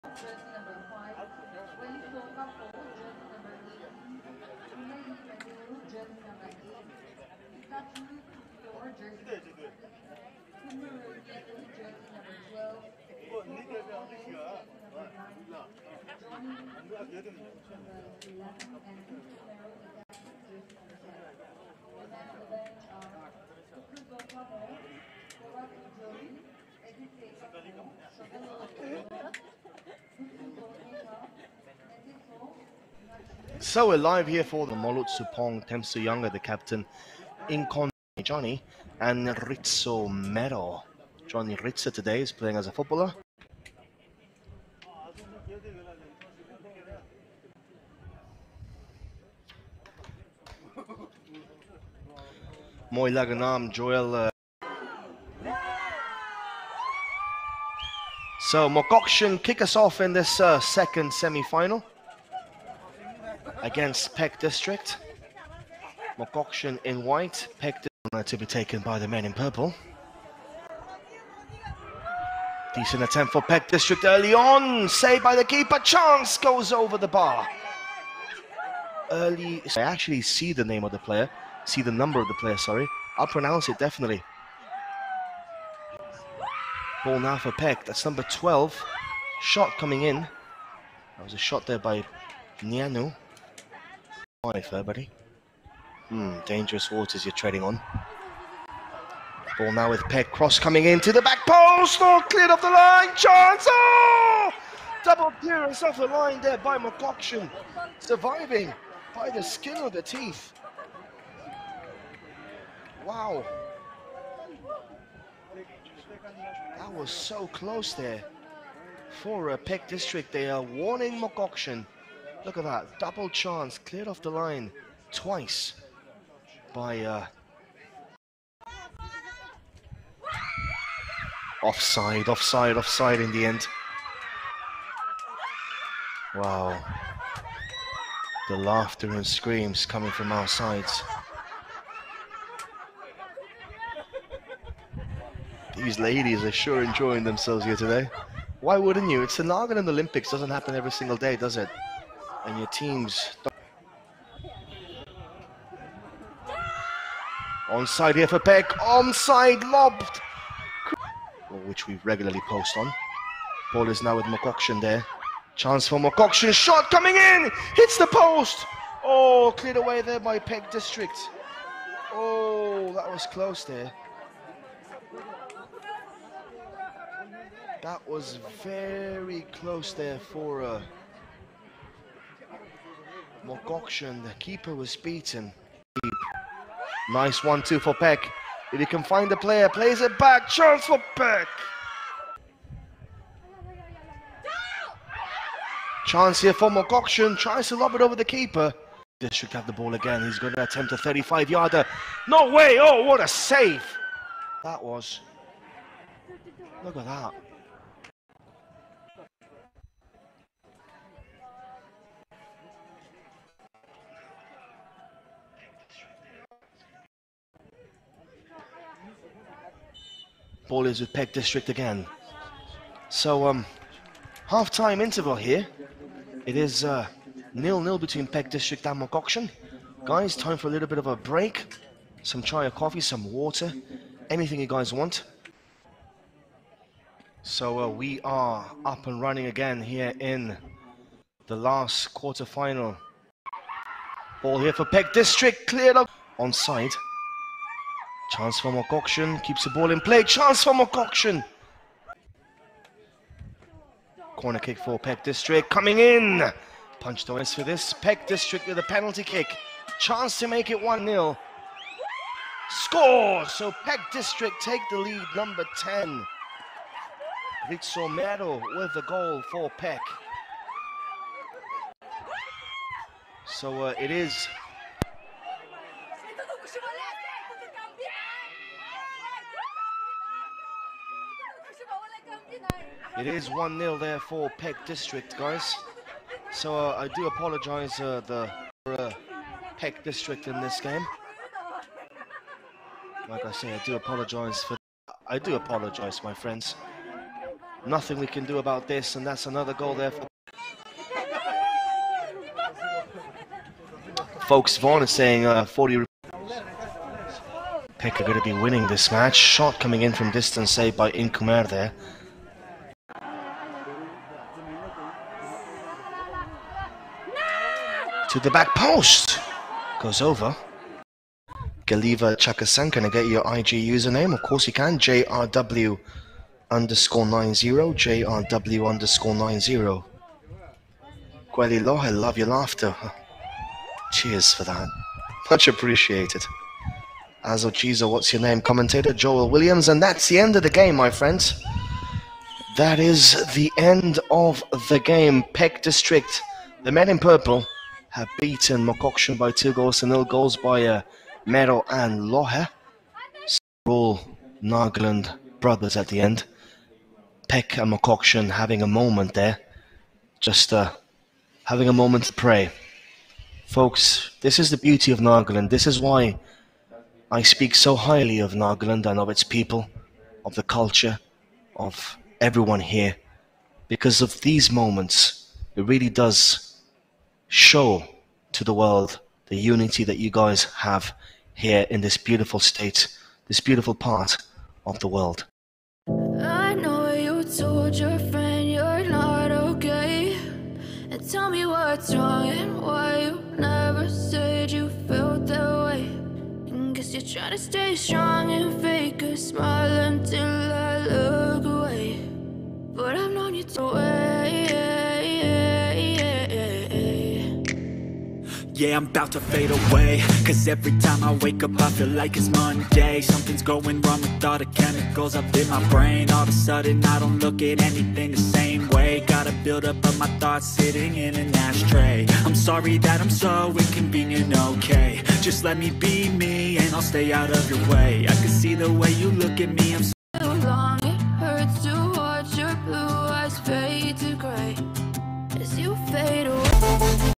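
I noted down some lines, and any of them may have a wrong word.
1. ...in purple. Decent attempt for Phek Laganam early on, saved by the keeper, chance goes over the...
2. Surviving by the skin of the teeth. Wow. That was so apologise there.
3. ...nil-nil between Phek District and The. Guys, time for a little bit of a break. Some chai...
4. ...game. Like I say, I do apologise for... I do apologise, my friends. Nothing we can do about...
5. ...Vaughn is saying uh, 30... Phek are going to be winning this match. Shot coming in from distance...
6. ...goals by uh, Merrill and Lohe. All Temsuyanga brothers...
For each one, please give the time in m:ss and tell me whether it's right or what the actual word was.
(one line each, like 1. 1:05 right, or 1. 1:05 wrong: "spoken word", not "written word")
1. 1:09 wrong: "District", not "Laganam"
2. 1:47 wrong: "close", not "apologise"
3. 3:47 wrong: "Auction", not "The"
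4. 4:50 right
5. 5:04 wrong: "40", not "30"
6. 5:50 wrong: "Nagaland", not "Temsuyanga".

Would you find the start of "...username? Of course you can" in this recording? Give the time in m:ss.
5:23.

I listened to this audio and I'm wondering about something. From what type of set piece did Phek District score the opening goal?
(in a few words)
Penalty kick.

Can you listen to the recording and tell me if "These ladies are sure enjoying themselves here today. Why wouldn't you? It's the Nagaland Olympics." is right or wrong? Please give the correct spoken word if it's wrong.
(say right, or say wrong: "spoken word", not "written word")
right.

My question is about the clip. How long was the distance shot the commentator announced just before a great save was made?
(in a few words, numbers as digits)
35 yards.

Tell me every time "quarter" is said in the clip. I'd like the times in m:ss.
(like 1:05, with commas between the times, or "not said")
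4:02.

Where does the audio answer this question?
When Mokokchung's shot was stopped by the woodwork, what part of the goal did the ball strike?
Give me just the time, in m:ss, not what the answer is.
2:47.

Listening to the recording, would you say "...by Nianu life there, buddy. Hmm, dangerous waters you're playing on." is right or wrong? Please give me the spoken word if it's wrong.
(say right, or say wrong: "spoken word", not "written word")
wrong: "treading", not "playing".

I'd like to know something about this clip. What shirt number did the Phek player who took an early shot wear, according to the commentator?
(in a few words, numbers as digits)
12.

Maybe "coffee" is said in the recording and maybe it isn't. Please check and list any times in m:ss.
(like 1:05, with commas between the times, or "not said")
3:52.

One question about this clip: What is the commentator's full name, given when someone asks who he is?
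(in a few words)
Joel Williams.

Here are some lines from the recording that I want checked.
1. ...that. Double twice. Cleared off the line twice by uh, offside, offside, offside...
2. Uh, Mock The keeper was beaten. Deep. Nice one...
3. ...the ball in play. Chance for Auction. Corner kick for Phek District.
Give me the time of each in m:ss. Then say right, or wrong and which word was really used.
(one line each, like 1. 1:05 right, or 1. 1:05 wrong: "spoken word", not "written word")
1. 2:02 wrong: "chance", not "twice"
2. 3:00 right
3. 4:09 wrong: "Mokokchung", not "Auction".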